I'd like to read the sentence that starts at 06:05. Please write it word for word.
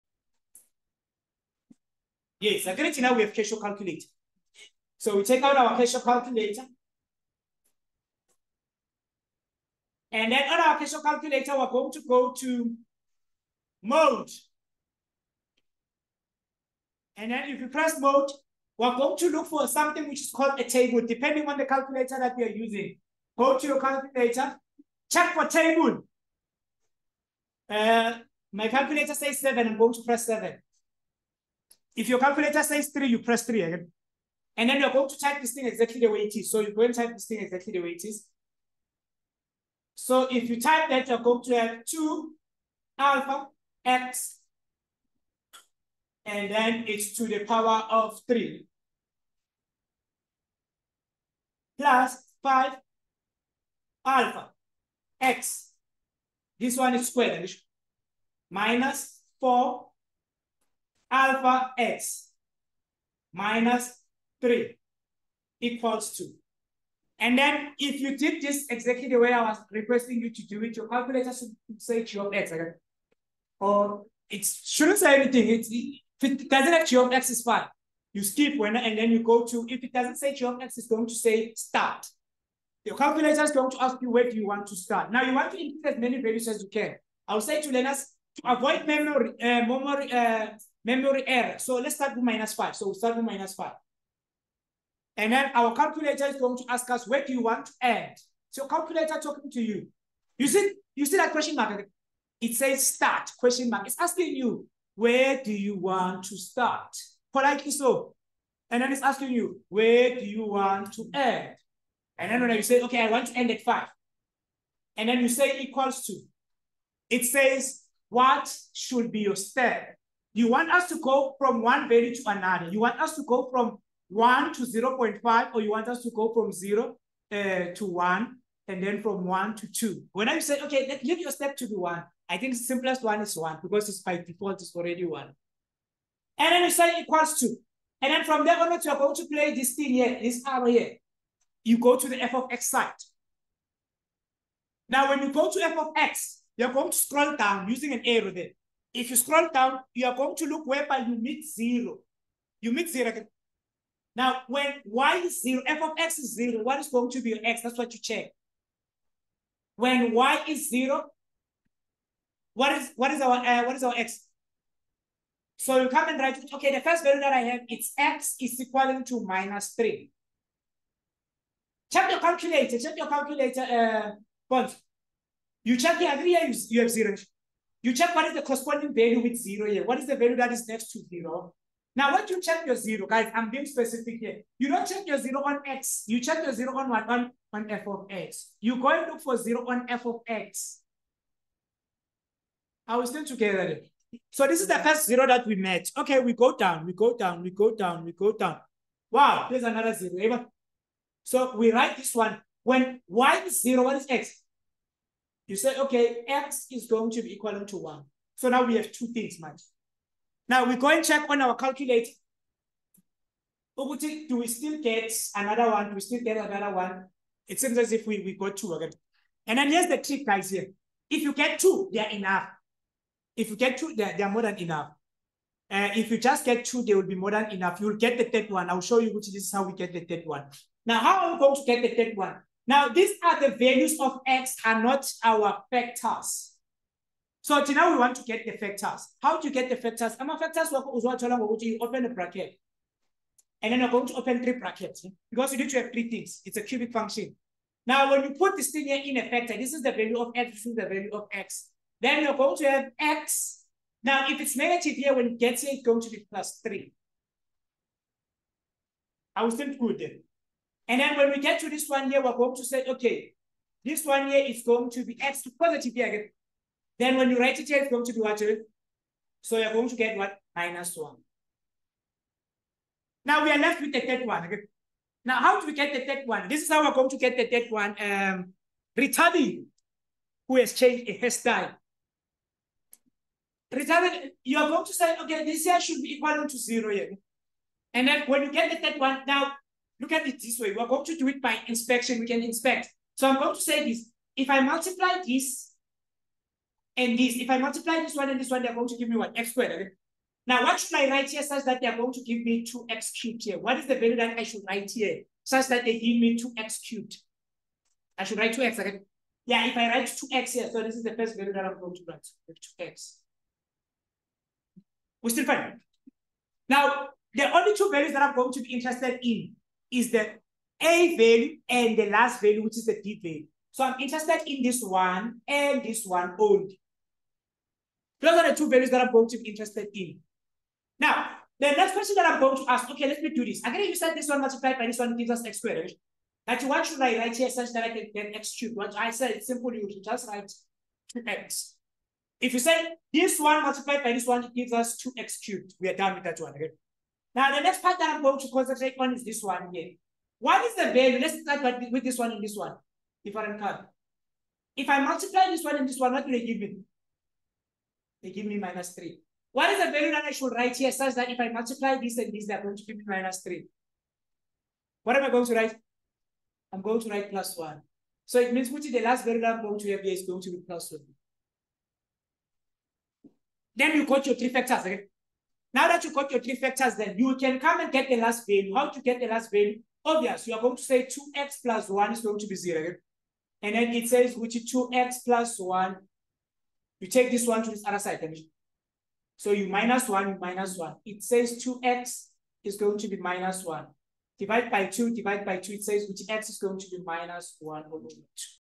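What am I going to write?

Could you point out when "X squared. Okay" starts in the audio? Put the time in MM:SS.
04:59.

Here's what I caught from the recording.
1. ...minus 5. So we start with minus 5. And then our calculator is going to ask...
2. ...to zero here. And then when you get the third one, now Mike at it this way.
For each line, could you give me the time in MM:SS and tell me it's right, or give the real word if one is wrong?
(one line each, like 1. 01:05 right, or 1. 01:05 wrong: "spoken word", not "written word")
1. 01:32 right
2. 04:46 wrong: "Look", not "Mike".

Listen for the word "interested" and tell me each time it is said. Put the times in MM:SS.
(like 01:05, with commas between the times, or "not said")
05:18, 05:23, 05:29.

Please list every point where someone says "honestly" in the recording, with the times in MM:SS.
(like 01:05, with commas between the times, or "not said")
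not said.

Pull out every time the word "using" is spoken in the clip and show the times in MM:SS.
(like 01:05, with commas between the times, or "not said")
00:22, 02:27.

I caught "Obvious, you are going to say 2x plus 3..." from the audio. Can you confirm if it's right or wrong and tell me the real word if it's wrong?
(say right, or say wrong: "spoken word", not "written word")
wrong: "1", not "3".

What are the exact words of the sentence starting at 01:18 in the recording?
You skip when and then you go to, if it doesn't say g of x, it's going to say start.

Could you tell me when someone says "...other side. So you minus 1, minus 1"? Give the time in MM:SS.
06:27.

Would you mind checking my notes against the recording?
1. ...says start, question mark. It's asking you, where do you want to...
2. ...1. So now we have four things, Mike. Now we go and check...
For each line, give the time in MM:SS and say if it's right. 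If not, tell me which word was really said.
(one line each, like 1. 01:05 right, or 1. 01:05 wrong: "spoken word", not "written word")
1. 01:42 right
2. 03:27 wrong: "two", not "four".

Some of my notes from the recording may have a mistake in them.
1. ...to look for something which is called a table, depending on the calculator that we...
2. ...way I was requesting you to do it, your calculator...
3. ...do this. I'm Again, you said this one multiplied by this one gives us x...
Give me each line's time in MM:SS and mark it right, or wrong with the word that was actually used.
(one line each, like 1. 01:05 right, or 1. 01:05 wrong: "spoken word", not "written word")
1. 00:19 right
2. 01:09 right
3. 05:33 right.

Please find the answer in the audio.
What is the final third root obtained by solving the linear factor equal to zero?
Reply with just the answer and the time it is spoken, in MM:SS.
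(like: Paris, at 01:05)
-1/2, at 06:37.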